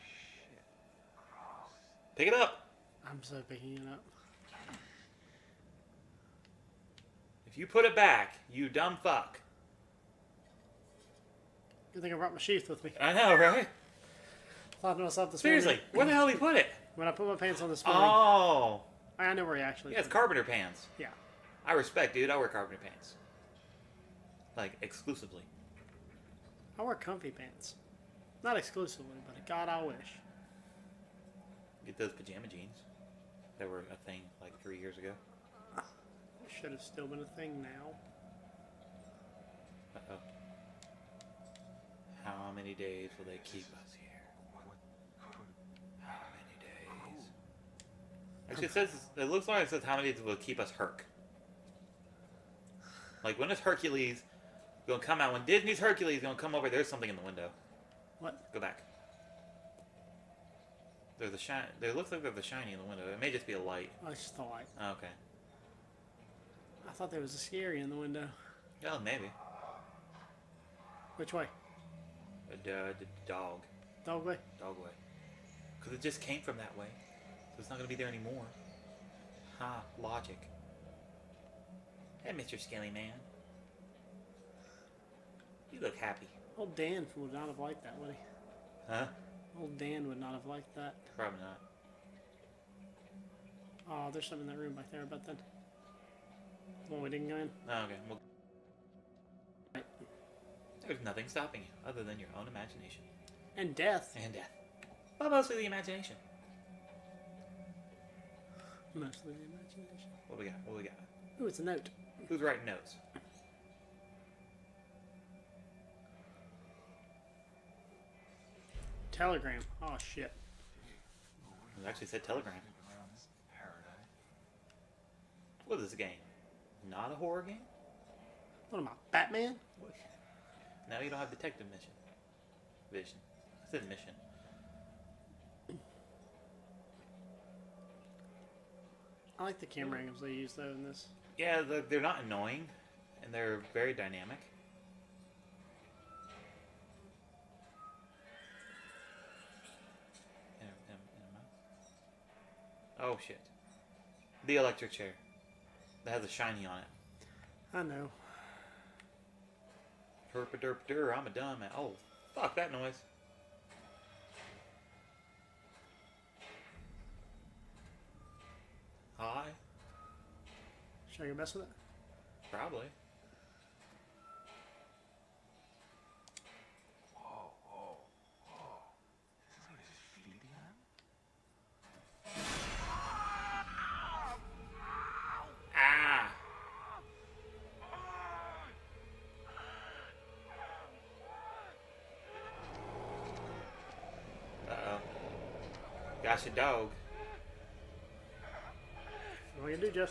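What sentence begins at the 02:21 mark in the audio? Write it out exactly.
Yeah, they're not annoying, and they're very dynamic.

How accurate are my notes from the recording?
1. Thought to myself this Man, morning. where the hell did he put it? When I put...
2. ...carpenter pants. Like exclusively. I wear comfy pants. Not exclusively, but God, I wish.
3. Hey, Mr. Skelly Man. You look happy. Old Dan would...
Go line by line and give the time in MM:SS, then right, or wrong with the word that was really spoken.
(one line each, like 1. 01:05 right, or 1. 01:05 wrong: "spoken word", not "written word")
1. 00:14 wrong: "Seriously", not "Man"
2. 00:22 right
3. 01:22 right.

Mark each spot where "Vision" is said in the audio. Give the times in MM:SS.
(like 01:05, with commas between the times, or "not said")
02:12.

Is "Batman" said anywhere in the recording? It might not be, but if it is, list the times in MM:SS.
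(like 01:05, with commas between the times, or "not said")
02:09.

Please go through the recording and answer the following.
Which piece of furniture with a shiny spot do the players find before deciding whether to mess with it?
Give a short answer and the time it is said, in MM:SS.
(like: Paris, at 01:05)
The electric chair, at 02:34.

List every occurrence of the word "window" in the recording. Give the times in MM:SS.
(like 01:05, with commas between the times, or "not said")
00:57, 01:02, 01:07.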